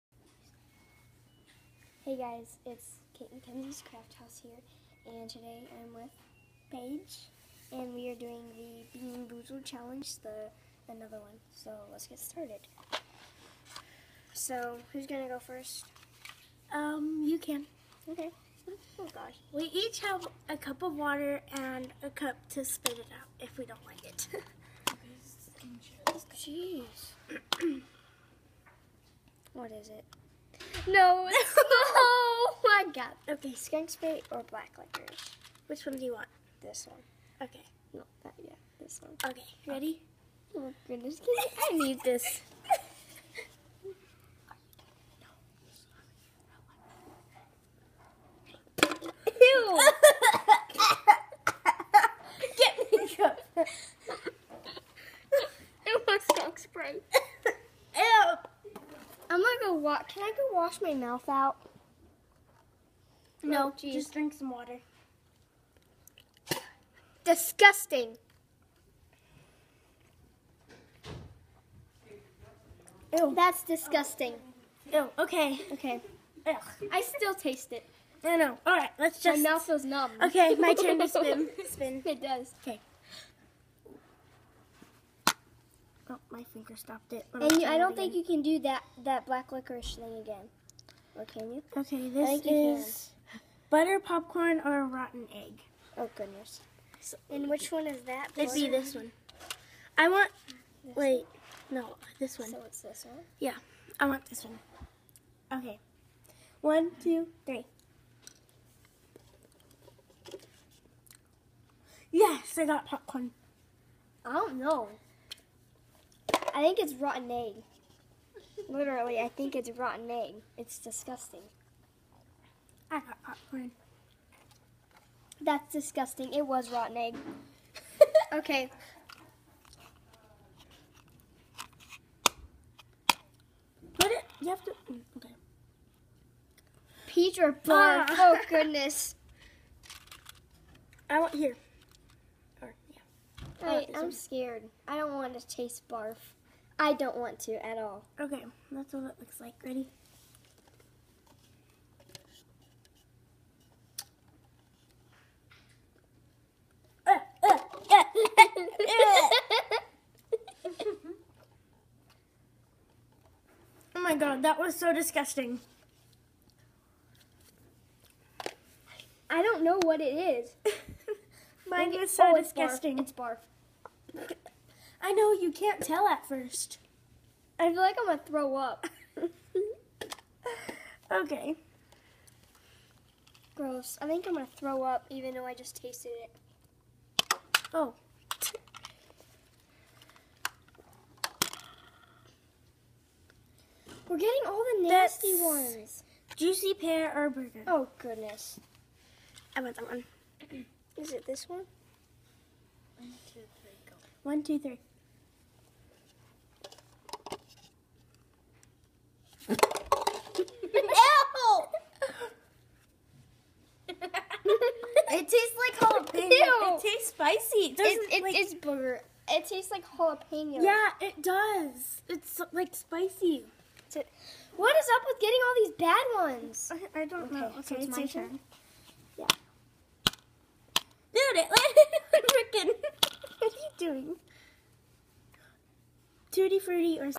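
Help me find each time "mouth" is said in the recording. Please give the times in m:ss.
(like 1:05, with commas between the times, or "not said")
1:00, 1:19.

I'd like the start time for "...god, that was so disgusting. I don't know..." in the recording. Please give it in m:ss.
2:44.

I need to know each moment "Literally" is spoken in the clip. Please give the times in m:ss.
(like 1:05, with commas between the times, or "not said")
1:58.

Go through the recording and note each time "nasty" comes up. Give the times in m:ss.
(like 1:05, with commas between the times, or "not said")
3:14.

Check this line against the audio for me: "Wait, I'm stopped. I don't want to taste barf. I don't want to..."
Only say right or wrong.
wrong.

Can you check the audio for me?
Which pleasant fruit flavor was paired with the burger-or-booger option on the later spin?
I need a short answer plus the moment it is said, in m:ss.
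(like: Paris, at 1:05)
Juicy pear, at 3:16.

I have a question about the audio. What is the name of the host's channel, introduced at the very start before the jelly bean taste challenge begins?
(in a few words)
Kate McKenzie's Craft House.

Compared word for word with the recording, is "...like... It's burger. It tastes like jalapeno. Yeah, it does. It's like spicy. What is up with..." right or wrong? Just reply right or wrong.
wrong.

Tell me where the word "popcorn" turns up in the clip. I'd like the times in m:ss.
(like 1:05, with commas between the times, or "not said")
1:33, 1:52, 2:03.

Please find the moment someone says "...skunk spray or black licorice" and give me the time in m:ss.
0:33.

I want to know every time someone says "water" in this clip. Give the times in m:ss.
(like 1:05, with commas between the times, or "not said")
0:20, 1:04.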